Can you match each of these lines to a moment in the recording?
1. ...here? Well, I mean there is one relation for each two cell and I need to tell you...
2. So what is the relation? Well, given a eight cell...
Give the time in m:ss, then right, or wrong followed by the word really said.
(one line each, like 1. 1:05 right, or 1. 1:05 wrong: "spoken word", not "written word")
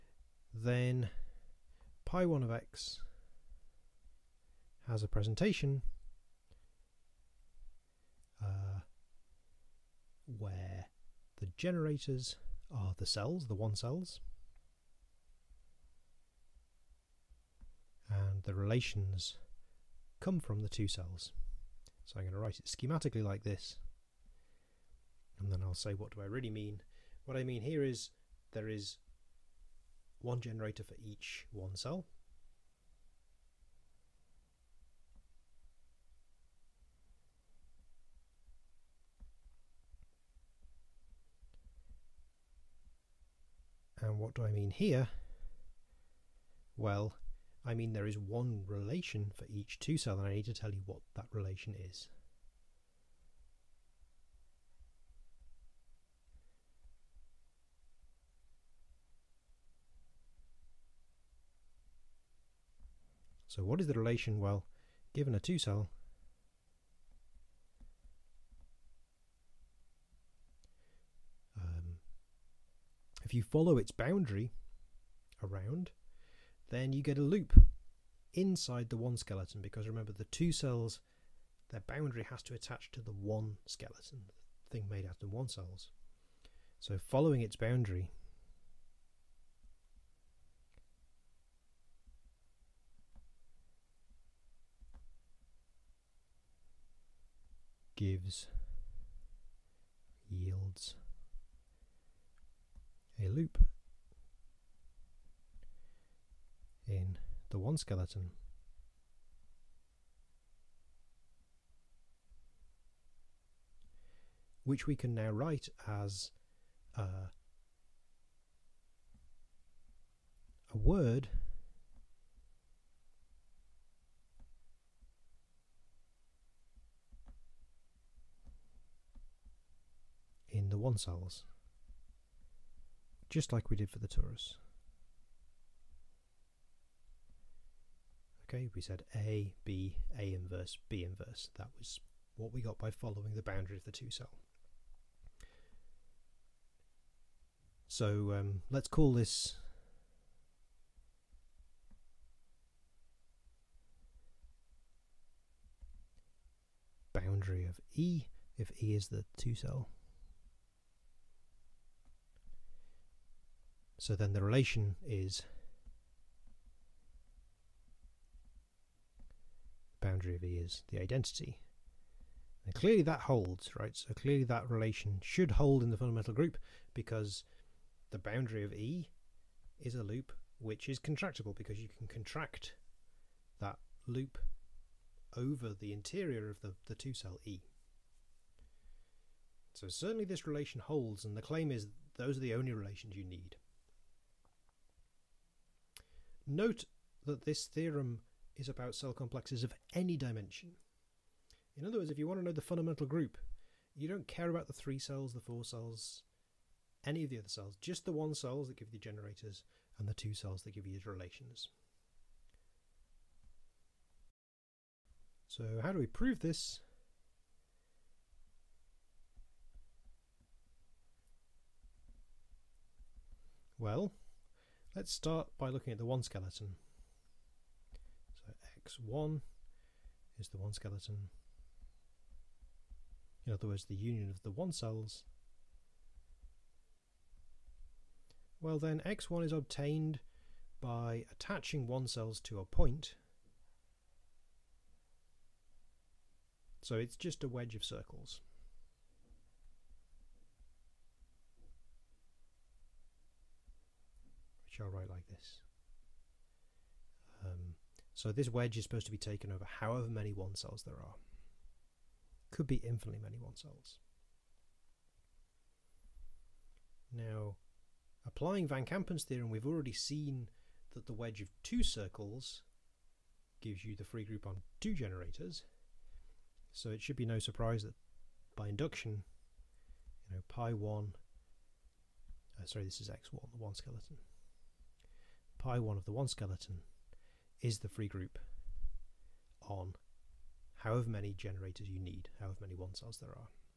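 1. 0:44 right
2. 1:03 wrong: "two", not "eight".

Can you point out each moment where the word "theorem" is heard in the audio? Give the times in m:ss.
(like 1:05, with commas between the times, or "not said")
3:17, 4:29.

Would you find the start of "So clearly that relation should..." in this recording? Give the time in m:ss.
2:53.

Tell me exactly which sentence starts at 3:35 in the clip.
So how do we prove this?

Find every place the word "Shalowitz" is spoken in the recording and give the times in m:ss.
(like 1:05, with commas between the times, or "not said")
not said.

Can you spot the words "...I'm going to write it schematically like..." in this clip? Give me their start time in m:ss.
0:22.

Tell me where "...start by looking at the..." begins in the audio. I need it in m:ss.
3:45.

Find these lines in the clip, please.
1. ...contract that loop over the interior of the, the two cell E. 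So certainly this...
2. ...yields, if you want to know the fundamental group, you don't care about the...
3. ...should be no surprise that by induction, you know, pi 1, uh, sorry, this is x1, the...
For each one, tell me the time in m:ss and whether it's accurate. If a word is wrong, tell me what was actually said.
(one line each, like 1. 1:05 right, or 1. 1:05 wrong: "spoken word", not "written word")
1. 3:02 right
2. 3:21 wrong: "words", not "yields"
3. 4:37 right.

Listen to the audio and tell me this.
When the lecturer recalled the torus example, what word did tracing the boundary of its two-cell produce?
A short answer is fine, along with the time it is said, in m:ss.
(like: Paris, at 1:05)
A, B, A inverse, B inverse, at 2:19.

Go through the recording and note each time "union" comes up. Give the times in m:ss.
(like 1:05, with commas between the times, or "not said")
3:53.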